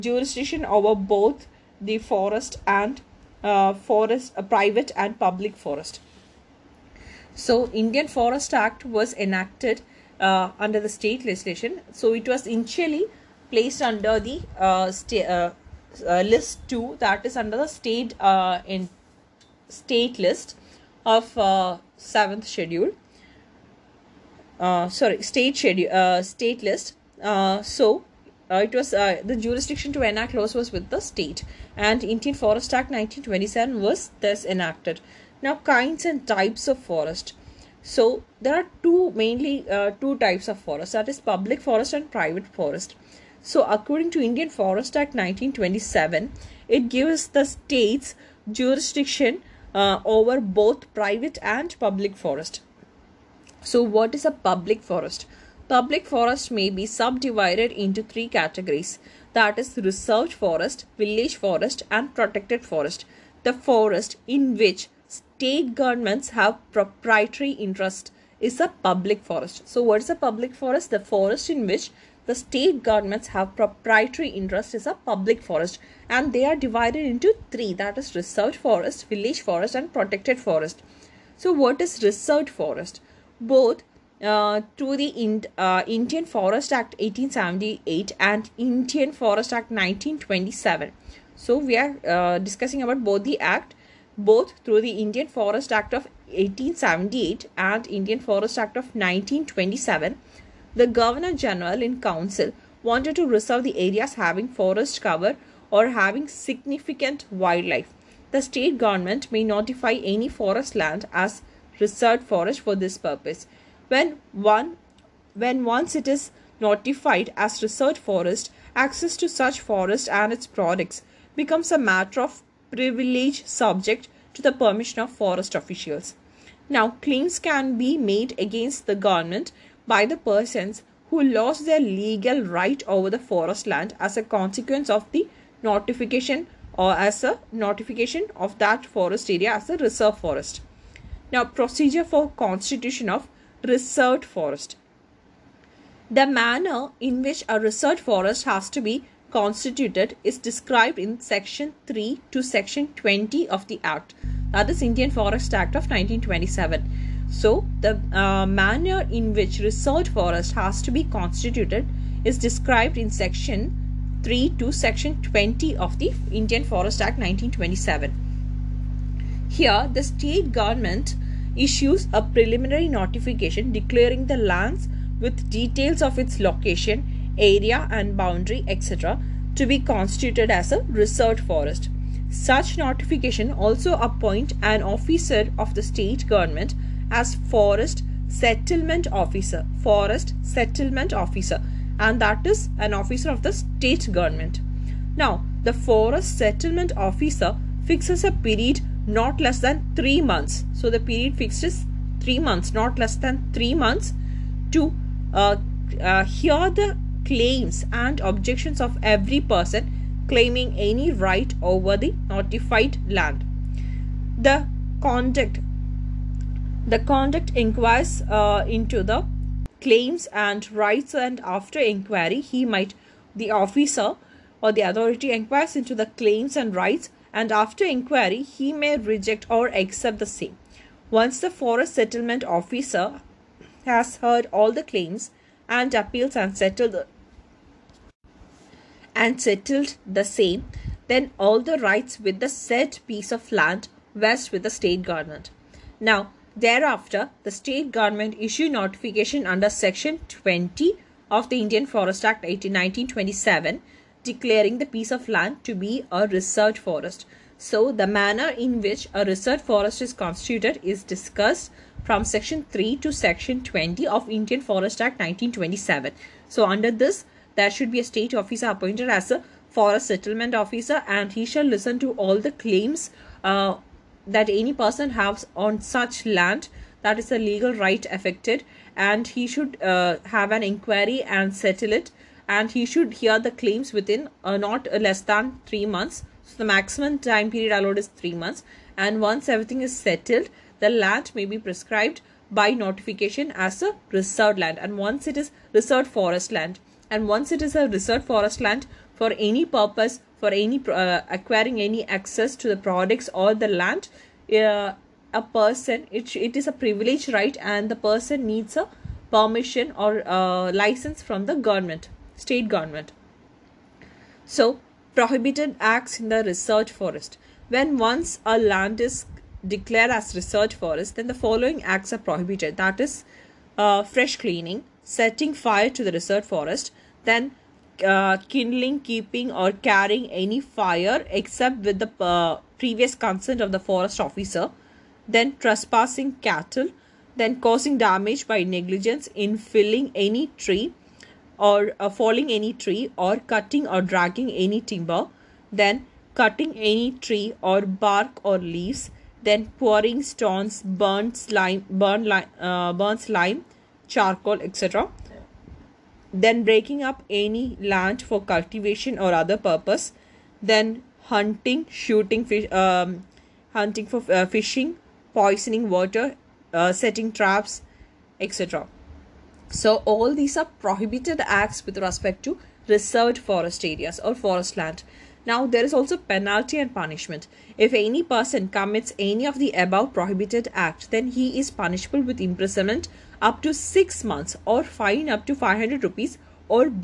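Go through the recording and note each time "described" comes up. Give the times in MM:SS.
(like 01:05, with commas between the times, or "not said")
02:30, 02:42.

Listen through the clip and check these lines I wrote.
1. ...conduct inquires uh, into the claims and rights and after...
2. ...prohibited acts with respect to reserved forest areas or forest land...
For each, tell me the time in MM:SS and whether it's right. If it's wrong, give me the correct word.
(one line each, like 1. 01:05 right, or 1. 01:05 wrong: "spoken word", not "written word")
1. 03:36 right
2. 06:10 right.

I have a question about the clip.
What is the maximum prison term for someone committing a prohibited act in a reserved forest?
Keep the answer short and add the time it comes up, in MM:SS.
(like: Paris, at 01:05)
6 months, at 06:23.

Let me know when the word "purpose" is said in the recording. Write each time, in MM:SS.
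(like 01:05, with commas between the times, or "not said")
01:52, 04:59, 05:59.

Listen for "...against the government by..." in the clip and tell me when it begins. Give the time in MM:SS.
02:08.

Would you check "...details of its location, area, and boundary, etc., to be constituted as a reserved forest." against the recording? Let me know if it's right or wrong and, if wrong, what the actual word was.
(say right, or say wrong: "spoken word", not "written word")
right.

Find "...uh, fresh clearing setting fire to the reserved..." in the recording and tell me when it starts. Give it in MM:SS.
05:23.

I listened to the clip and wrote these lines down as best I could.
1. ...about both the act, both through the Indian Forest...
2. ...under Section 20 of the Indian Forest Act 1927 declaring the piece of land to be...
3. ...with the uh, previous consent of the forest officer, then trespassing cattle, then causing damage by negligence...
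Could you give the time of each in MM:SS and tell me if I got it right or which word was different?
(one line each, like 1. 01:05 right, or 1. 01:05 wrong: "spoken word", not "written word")
1. 01:32 right
2. 04:09 right
3. 05:31 right.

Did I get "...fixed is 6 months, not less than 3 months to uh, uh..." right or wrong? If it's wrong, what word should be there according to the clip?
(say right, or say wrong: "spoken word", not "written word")
wrong: "3", not "6".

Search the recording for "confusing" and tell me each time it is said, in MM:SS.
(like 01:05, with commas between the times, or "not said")
not said.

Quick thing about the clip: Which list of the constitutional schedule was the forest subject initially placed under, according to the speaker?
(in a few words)
List 2.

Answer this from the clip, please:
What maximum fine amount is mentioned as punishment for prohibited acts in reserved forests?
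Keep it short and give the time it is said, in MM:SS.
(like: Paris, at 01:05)
500 rupees, at 06:25.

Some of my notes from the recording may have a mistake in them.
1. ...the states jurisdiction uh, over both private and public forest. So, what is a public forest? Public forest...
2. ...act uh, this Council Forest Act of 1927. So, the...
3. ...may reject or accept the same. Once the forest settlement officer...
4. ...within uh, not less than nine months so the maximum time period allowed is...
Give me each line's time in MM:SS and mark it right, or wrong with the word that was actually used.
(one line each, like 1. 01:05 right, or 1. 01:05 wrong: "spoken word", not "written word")
1. 00:47 right
2. 02:33 wrong: "Indian", not "Council"
3. 03:48 right
4. 04:43 wrong: "three", not "nine".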